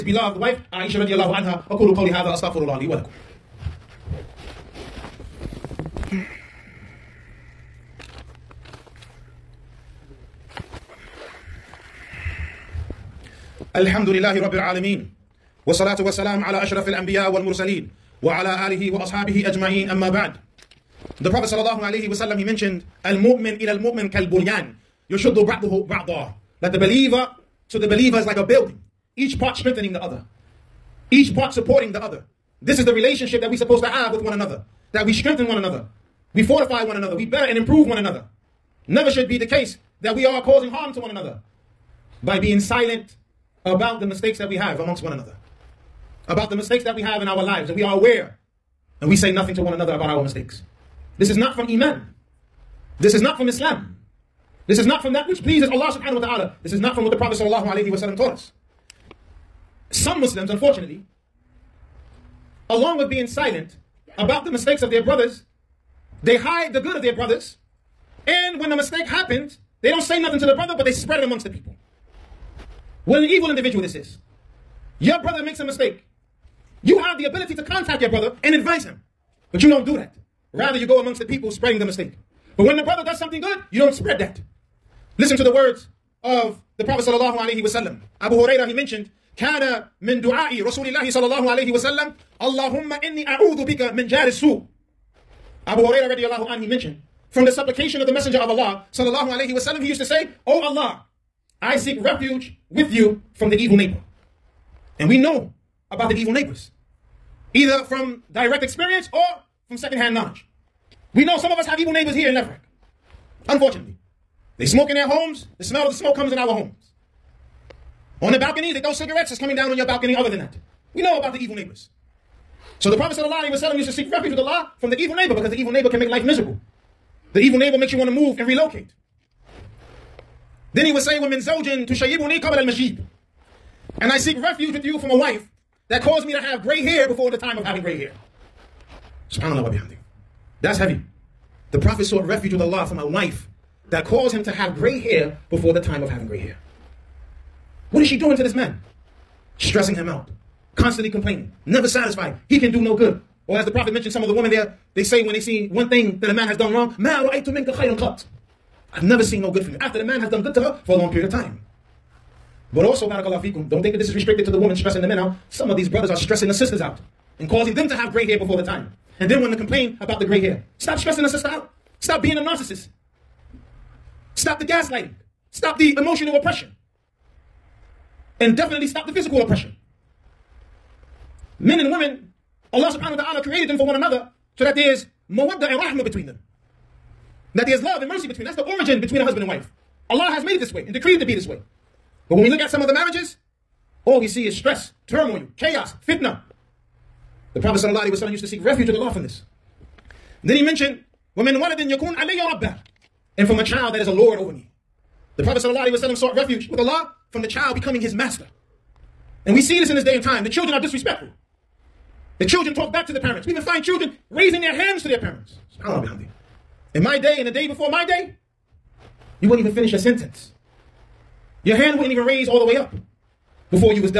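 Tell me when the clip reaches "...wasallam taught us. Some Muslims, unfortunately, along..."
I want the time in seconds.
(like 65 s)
57 s.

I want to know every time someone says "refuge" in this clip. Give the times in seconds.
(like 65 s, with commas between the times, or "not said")
101 s, 124 s, 134 s, 142 s, 198 s, 206 s.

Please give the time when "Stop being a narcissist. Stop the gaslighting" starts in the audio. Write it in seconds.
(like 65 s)
172 s.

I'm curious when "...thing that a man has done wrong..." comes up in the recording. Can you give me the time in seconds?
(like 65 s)
155 s.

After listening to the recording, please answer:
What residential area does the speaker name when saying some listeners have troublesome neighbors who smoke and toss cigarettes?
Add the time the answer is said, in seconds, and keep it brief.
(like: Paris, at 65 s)
Lefrak, at 112 s.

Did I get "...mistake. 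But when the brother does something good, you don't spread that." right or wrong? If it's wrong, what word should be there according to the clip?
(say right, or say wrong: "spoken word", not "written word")
right.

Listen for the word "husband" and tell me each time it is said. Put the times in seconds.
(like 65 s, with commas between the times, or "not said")
189 s.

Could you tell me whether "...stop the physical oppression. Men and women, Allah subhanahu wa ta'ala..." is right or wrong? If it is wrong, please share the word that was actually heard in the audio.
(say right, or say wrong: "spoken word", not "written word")
right.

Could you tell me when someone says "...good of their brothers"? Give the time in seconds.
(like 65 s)
66 s.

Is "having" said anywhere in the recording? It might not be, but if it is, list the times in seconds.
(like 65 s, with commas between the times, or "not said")
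137 s, 146 s.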